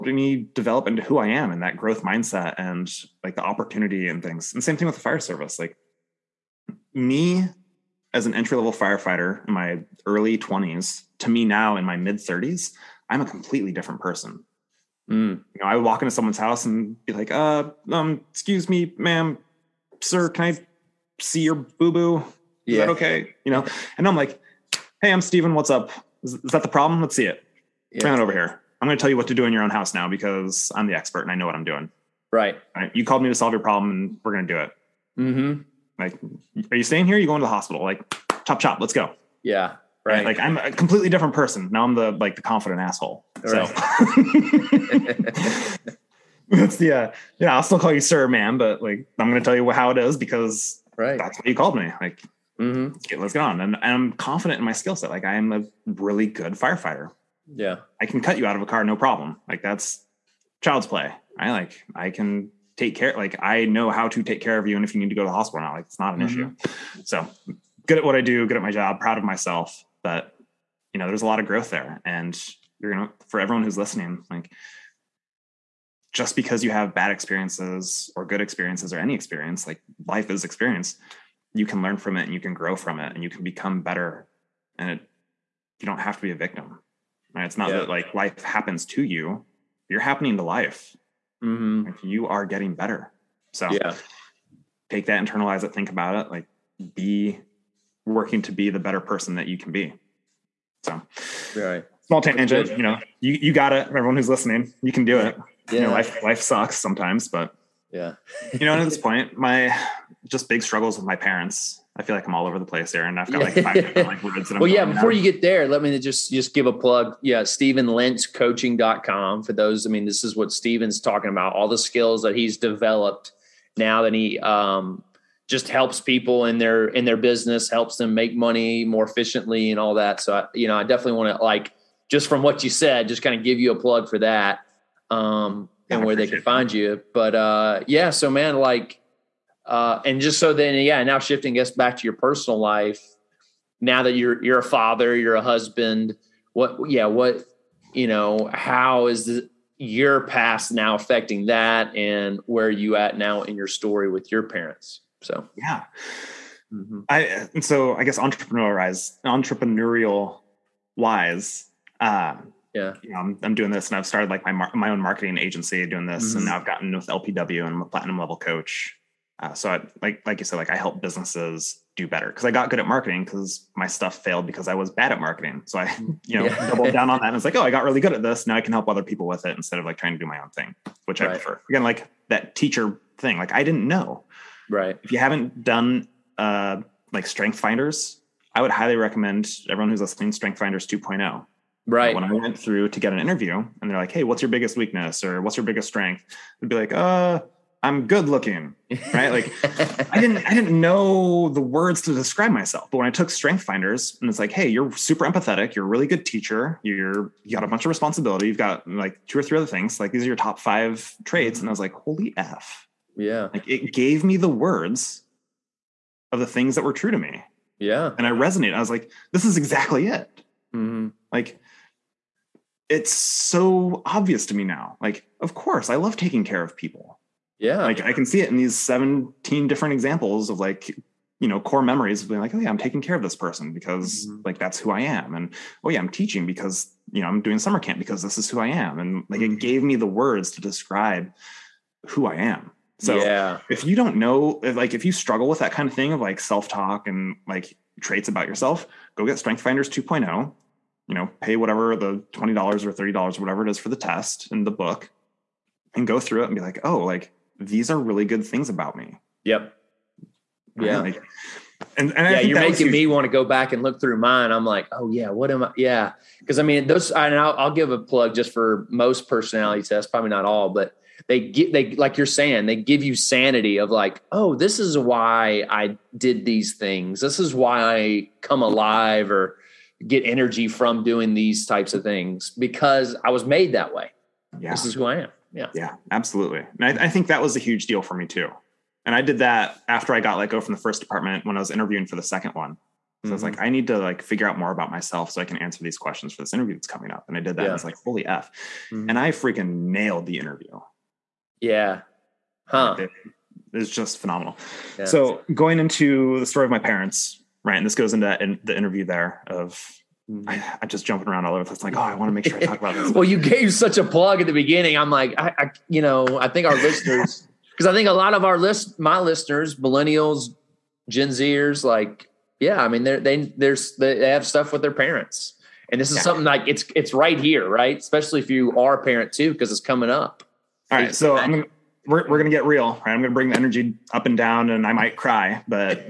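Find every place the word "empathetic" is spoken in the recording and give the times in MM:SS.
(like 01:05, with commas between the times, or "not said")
03:25.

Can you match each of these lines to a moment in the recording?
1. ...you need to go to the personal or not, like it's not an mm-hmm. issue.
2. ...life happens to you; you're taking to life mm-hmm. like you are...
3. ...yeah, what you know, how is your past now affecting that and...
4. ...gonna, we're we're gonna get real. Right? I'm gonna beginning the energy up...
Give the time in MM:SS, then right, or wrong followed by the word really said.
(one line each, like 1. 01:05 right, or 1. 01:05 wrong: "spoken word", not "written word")
1. 01:04 wrong: "hospital", not "personal"
2. 01:28 wrong: "happening", not "taking"
3. 02:26 right
4. 05:31 wrong: "bring", not "beginning".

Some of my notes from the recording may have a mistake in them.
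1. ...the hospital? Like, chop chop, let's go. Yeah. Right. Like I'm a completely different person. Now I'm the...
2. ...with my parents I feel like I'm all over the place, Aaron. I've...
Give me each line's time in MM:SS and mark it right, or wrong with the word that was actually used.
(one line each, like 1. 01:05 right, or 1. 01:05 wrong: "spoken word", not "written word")
1. 00:37 right
2. 01:50 right.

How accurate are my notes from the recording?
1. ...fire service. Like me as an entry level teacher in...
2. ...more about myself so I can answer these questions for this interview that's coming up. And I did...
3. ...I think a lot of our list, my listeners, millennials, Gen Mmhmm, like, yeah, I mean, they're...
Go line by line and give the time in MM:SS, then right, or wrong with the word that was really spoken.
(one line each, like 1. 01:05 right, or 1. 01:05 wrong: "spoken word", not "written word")
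1. 00:05 wrong: "firefighter", not "teacher"
2. 04:54 right
3. 05:17 wrong: "Zers", not "Mmhmm".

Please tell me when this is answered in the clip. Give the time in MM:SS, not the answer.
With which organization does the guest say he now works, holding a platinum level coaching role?
02:47.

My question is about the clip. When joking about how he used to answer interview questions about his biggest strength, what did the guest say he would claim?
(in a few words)
I'm good looking.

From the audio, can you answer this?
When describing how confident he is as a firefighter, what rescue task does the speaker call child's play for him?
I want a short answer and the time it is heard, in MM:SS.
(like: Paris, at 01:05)
Cut you out of a car, at 00:58.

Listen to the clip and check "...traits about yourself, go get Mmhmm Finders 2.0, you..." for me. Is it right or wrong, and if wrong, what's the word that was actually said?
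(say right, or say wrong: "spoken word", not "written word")
wrong: "Strength", not "Mmhmm".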